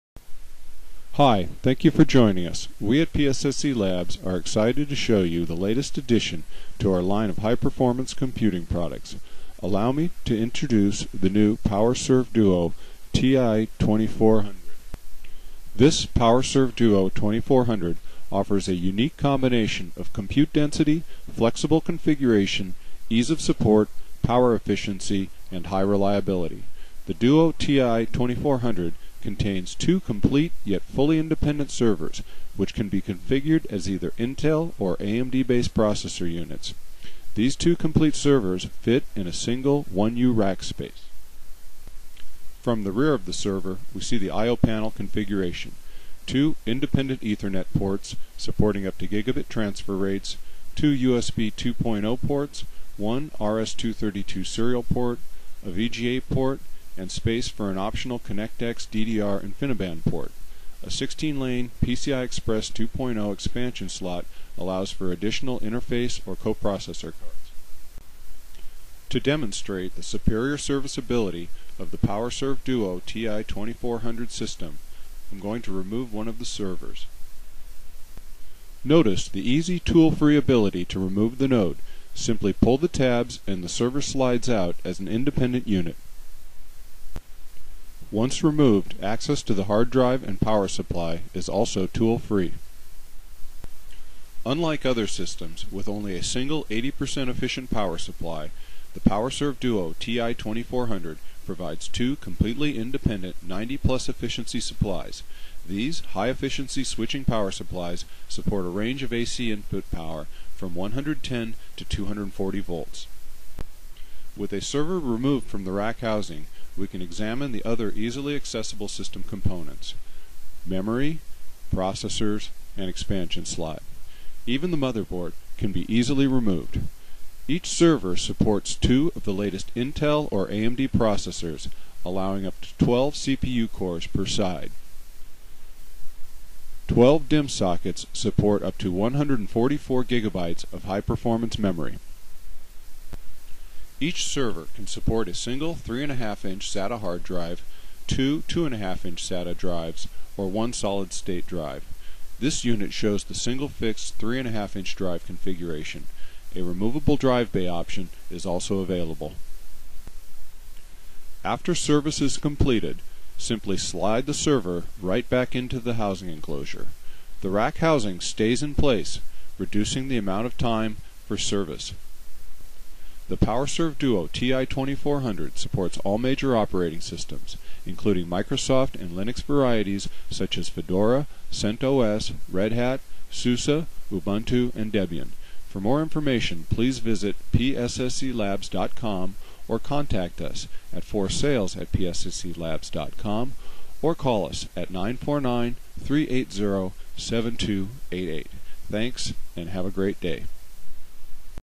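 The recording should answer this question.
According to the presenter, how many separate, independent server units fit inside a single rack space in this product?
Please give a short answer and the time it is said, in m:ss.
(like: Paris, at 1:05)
2, at 0:29.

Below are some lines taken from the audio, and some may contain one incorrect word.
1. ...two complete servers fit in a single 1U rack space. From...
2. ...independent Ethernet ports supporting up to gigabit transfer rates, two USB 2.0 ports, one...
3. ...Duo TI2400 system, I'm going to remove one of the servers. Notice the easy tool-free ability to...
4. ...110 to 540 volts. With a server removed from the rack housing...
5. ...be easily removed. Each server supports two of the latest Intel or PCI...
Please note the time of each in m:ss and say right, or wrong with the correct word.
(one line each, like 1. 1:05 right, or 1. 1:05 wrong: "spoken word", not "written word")
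1. 0:37 right
2. 0:46 right
3. 1:12 right
4. 1:50 wrong: "240", not "540"
5. 2:05 wrong: "AMD", not "PCI".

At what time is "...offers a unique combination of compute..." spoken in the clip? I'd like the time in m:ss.
0:18.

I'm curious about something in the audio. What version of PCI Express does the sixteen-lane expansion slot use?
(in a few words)
2.0.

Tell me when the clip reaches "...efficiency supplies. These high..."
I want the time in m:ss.
1:44.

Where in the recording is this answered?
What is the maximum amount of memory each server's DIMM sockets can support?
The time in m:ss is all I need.
2:18.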